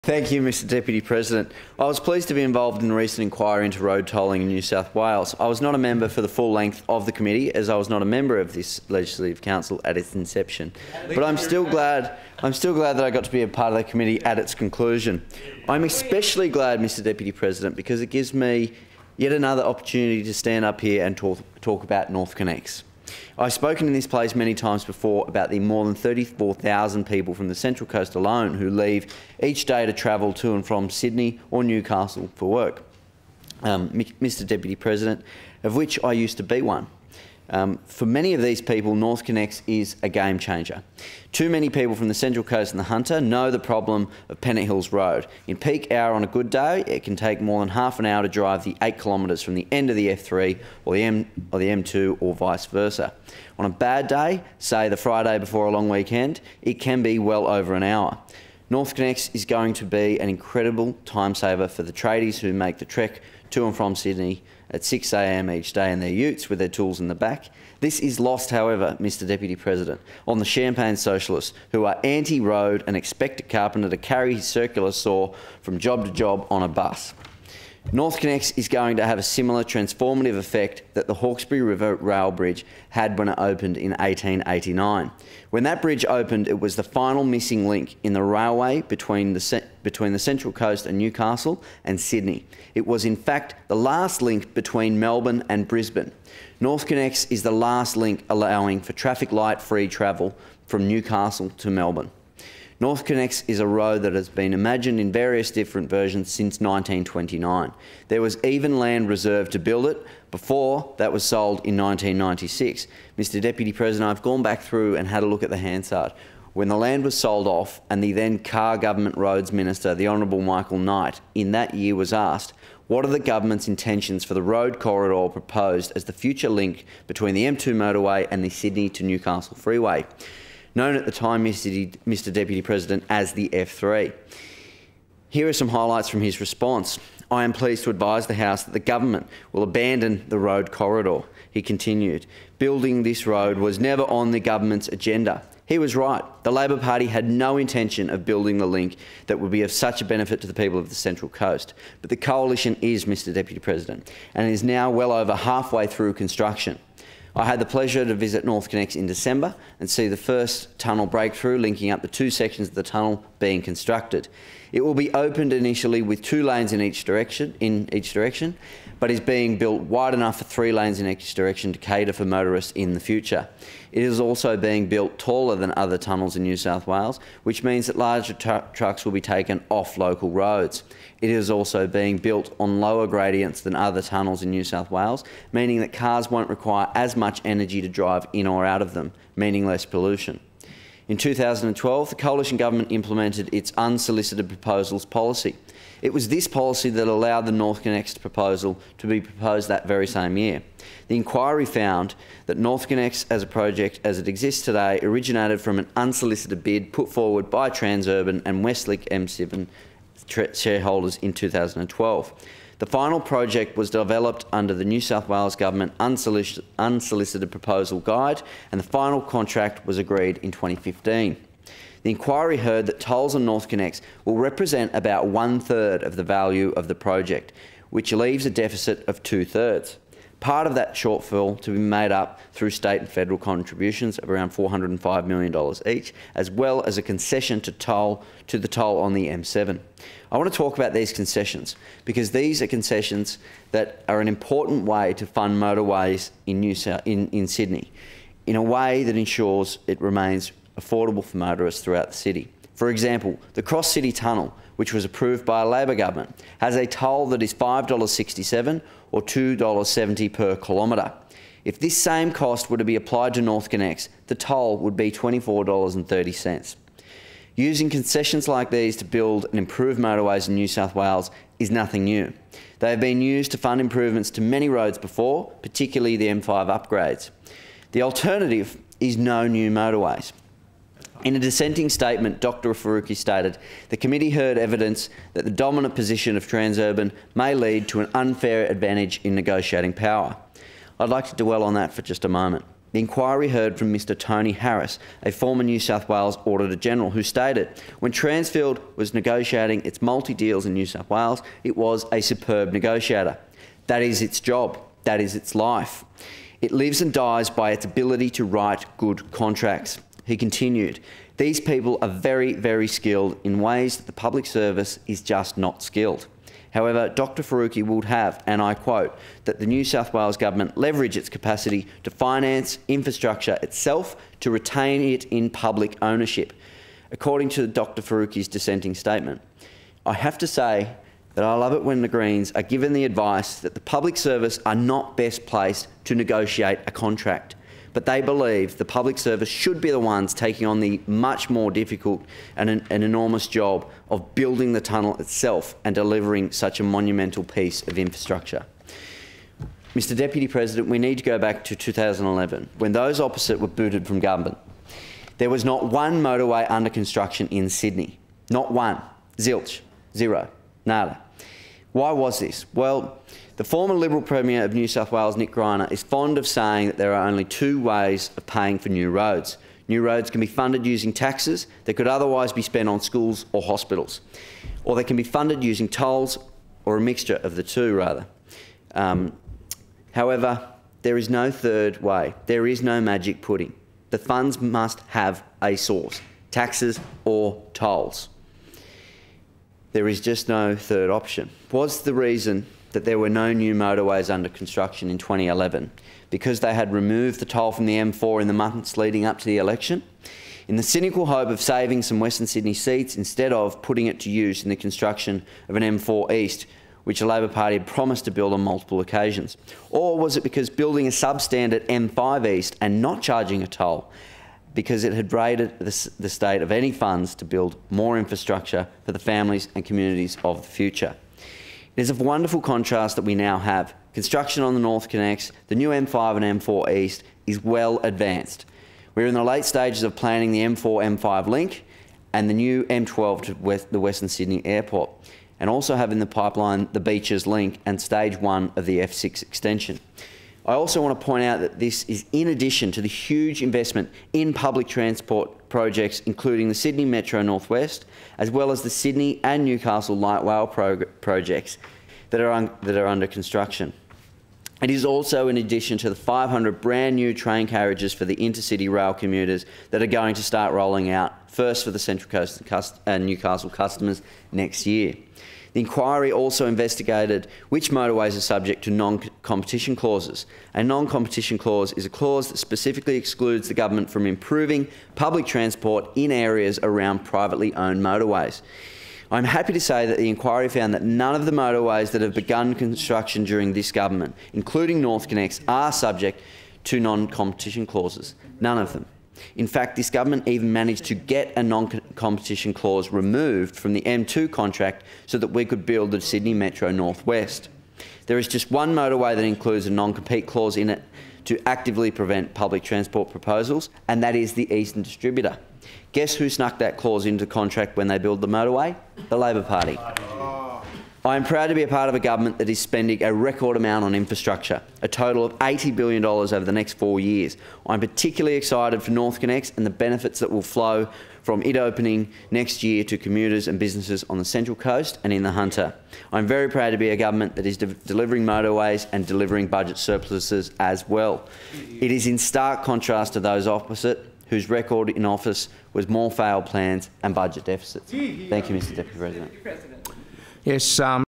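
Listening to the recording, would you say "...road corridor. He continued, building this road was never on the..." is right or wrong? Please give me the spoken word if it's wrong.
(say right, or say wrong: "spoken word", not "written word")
right.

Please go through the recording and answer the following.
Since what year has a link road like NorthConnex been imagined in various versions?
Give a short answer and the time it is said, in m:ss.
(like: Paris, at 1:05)
1929, at 1:46.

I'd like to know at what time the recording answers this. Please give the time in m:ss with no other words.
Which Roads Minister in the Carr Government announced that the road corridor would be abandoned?
2:00.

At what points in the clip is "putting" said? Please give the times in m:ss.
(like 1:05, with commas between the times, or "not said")
6:43.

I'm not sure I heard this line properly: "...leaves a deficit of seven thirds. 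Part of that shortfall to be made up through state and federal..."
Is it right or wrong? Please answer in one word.
wrong.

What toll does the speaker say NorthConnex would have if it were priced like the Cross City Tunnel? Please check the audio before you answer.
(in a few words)
$24.30.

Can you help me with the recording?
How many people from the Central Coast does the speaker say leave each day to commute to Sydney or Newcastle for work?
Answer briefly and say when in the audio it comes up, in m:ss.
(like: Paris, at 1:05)
34,000, at 0:25.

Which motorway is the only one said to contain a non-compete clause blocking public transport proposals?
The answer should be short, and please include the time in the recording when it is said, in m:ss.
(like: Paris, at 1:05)
Eastern Distributor, at 8:24.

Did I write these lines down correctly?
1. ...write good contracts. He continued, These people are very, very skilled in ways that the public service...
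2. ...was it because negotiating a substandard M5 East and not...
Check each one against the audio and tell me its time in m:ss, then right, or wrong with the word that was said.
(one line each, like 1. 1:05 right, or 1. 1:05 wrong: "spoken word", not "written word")
1. 5:08 right
2. 6:50 wrong: "building", not "negotiating".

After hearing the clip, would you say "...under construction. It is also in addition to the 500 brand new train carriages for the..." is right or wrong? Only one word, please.
right.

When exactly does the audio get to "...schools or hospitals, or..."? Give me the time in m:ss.
6:13.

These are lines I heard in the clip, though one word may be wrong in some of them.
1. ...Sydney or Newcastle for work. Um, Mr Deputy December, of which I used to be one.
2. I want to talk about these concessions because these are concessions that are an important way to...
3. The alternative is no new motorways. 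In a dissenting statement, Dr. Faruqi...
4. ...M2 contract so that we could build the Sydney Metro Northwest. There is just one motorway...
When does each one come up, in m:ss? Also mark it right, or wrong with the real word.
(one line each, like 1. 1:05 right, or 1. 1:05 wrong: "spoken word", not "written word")
1. 0:30 wrong: "President", not "December"
2. 4:00 right
3. 4:37 right
4. 8:14 right.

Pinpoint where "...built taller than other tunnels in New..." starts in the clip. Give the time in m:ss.
2:54.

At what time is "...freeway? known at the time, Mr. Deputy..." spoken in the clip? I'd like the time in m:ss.
2:09.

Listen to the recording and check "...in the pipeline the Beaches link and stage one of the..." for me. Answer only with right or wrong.
right.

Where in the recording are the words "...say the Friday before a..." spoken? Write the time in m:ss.
0:54.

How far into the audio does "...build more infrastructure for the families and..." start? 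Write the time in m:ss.
6:57.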